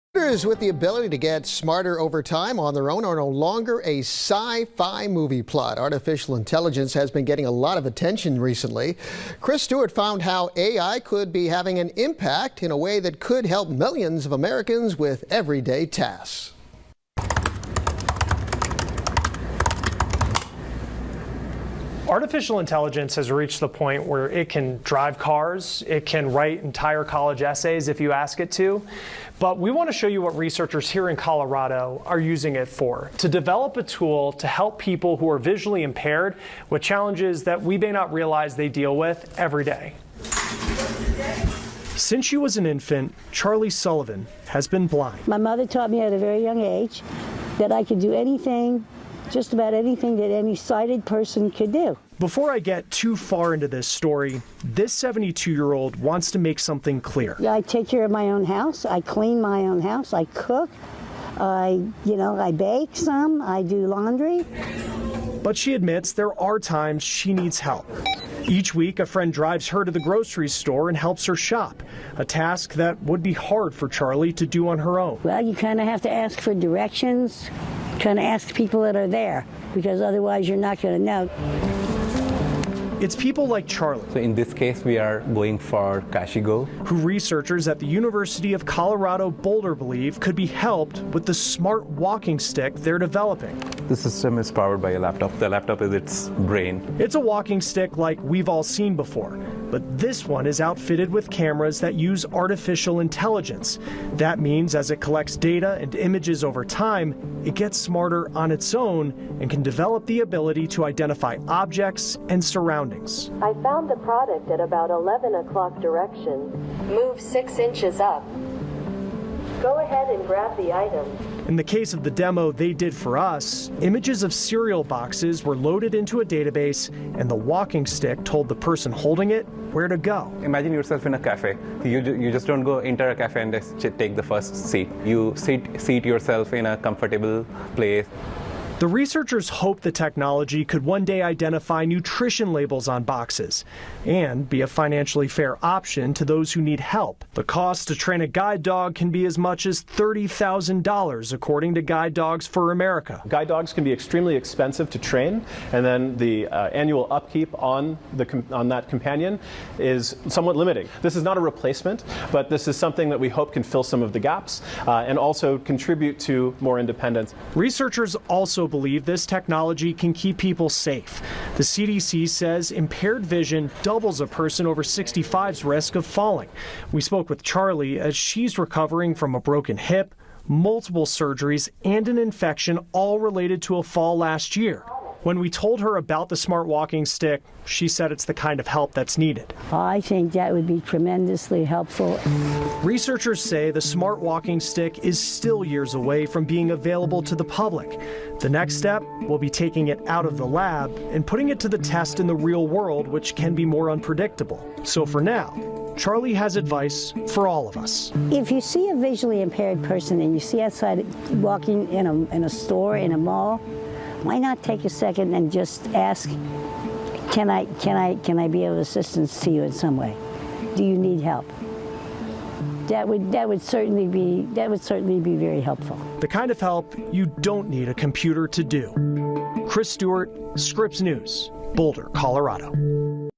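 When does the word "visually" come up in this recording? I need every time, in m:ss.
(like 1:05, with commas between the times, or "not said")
0:35, 3:28.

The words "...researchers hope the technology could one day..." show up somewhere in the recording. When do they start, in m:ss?
2:18.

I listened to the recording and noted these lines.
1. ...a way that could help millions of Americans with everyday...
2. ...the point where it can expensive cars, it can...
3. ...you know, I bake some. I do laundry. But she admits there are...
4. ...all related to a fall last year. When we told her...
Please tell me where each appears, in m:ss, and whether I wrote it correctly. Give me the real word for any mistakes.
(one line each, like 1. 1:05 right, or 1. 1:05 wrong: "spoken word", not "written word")
1. 0:12 right
2. 0:23 wrong: "drive", not "expensive"
3. 1:02 right
4. 3:02 right.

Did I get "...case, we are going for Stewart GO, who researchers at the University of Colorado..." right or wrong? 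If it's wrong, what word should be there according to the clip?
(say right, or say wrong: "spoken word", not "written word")
wrong: "Kashi", not "Stewart".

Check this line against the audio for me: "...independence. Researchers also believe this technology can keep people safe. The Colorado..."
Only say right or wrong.
wrong.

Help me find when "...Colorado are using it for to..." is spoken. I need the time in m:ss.
0:31.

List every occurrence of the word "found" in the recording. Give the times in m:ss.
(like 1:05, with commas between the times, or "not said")
0:09, 1:53.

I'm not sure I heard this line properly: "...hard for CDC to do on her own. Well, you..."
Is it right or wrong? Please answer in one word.
wrong.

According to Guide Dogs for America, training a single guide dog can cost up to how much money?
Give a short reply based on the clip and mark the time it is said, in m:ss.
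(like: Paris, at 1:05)
$30,000, at 2:29.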